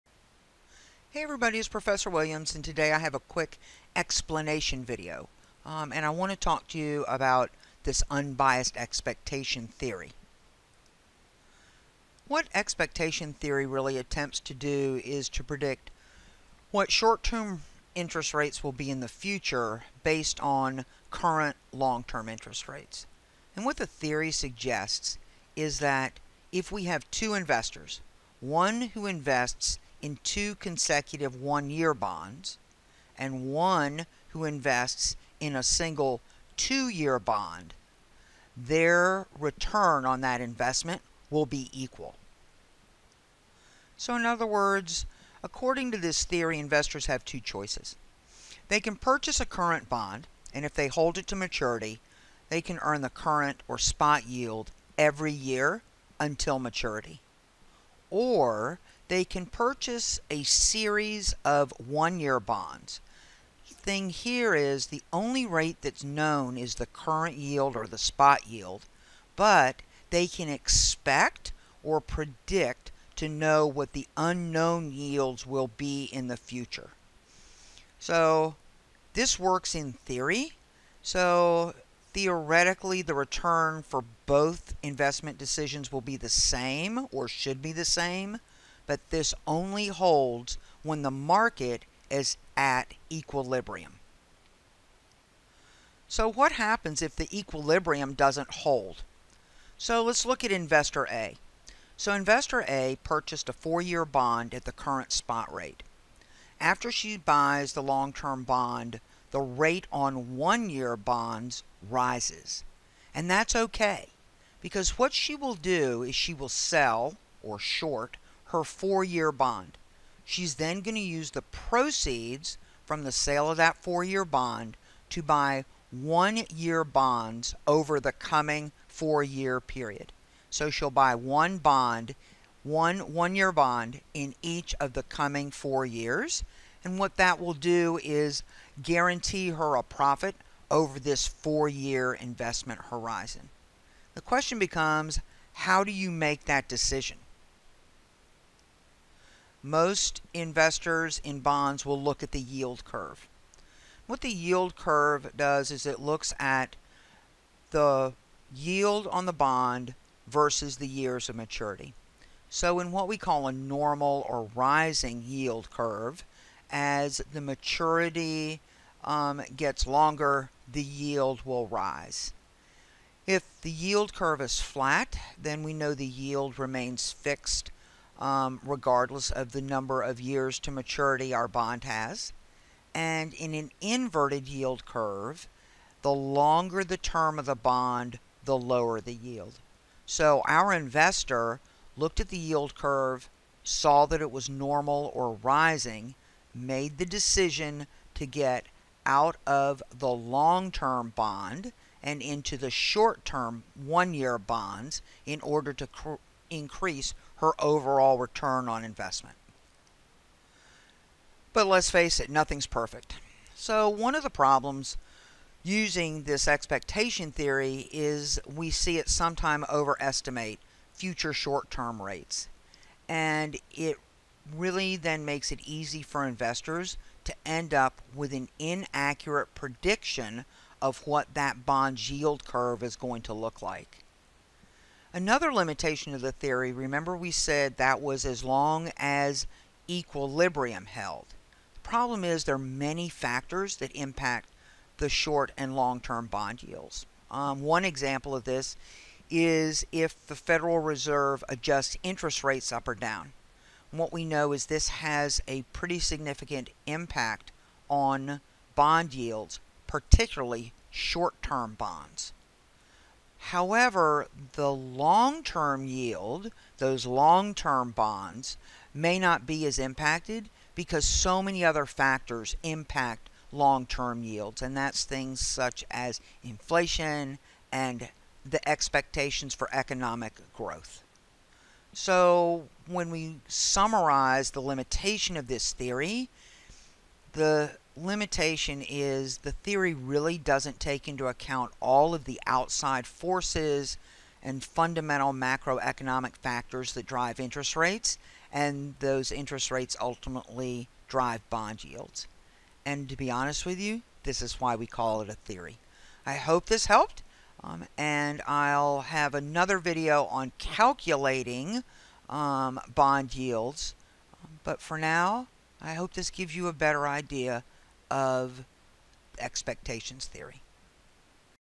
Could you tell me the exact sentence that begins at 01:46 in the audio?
After she buys the long term bond, the rate on one year bonds rises.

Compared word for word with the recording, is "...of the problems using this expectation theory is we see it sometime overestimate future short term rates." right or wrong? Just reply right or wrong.
right.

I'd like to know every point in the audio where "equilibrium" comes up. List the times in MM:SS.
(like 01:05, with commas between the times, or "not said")
01:33, 01:37, 03:59.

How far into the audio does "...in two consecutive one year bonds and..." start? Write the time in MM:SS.
00:30.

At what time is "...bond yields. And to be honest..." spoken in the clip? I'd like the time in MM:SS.
05:01.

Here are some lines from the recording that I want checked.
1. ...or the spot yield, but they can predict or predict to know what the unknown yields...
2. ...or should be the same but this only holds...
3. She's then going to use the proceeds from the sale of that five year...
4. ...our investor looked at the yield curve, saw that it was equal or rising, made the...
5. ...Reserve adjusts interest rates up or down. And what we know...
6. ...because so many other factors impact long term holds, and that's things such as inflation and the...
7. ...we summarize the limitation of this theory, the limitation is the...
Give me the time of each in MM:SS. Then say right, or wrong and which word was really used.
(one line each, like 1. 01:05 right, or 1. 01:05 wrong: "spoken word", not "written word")
1. 01:07 wrong: "expect", not "predict"
2. 01:27 right
3. 02:00 wrong: "four", not "five"
4. 03:10 wrong: "normal", not "equal"
5. 04:10 right
6. 04:30 wrong: "yields", not "holds"
7. 04:43 right.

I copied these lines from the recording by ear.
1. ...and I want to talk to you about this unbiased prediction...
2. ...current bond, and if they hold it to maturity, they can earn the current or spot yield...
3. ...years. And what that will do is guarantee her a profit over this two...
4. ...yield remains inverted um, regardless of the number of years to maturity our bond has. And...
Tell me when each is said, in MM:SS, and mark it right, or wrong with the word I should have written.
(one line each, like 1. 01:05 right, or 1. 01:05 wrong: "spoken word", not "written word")
1. 00:05 wrong: "expectation", not "prediction"
2. 00:49 right
3. 02:15 wrong: "four", not "two"
4. 02:56 wrong: "fixed", not "inverted".